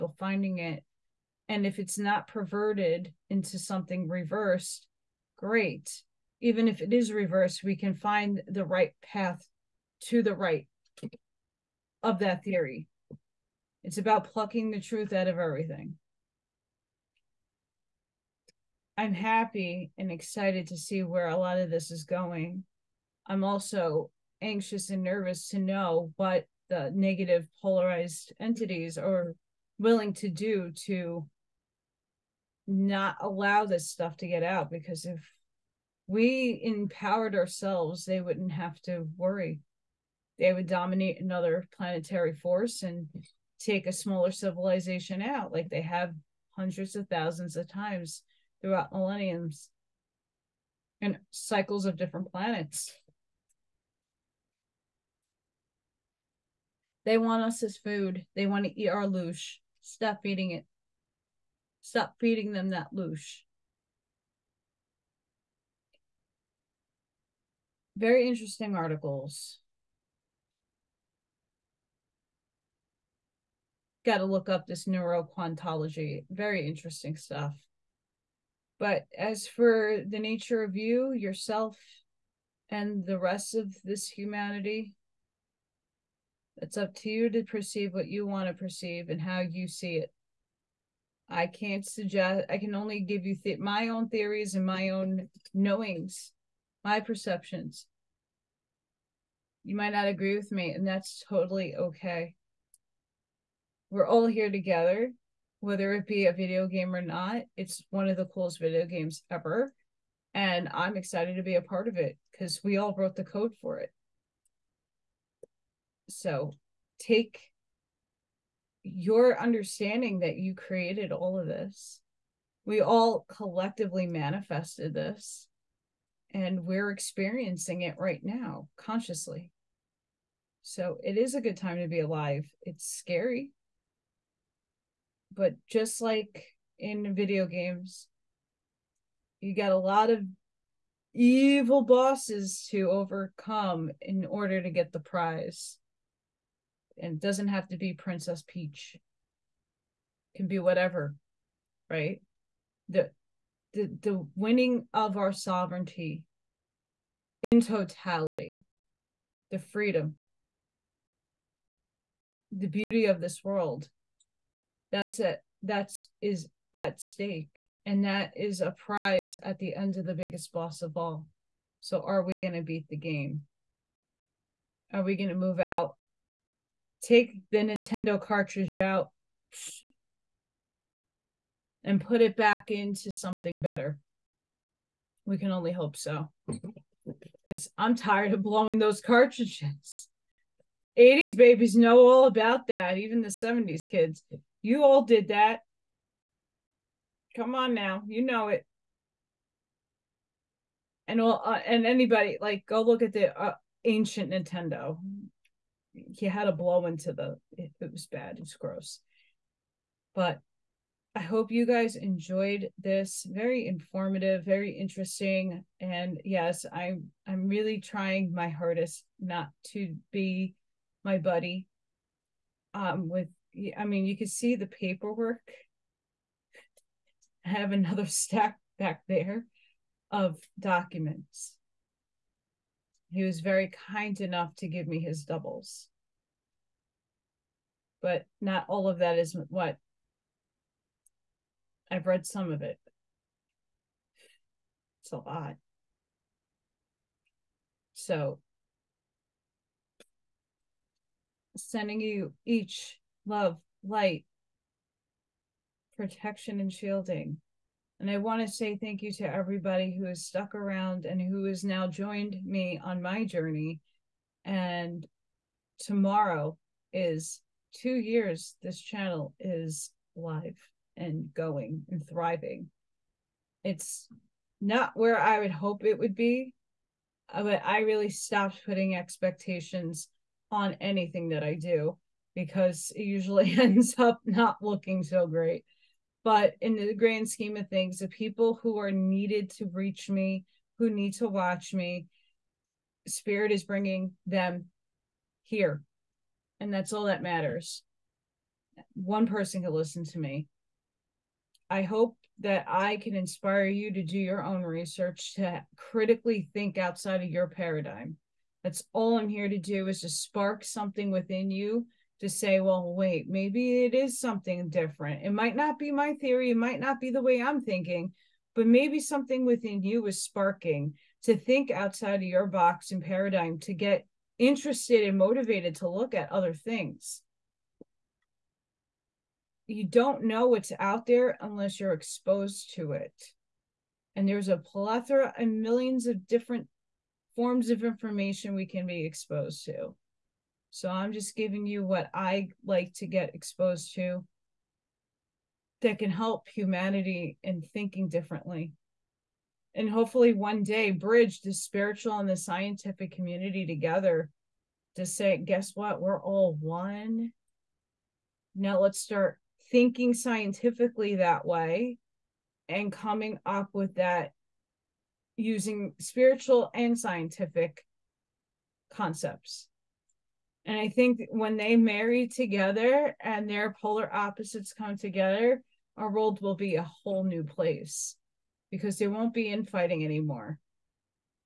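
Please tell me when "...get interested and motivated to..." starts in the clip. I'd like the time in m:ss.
5:23.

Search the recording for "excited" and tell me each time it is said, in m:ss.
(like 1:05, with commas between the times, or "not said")
0:20, 1:50.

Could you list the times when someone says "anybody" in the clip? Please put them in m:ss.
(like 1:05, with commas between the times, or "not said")
3:21.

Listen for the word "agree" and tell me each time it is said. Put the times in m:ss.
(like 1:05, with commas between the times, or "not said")
1:40.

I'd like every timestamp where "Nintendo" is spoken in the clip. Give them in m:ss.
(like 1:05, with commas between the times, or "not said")
2:57, 3:24.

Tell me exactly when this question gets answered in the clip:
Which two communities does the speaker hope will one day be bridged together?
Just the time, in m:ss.
5:51.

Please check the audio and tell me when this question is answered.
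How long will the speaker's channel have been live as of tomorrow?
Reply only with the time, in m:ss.
4:27.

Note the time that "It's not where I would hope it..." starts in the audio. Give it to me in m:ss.
4:33.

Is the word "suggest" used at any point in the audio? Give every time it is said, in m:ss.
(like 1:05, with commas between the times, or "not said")
1:31.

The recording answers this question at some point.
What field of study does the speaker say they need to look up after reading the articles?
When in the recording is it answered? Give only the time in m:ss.
1:14.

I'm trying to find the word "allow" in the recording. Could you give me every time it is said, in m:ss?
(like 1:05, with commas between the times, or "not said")
0:33.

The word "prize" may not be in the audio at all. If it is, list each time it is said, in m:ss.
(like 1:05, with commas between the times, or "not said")
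2:24, 2:48.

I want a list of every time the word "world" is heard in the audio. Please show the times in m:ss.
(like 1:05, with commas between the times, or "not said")
2:43, 6:16.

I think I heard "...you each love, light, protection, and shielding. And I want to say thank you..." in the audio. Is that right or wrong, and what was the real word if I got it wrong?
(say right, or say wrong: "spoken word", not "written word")
right.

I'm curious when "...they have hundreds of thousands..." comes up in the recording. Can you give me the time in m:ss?
0:45.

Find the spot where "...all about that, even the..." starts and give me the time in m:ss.
3:11.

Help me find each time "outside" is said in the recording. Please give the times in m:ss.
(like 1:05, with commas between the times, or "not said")
5:06, 5:21.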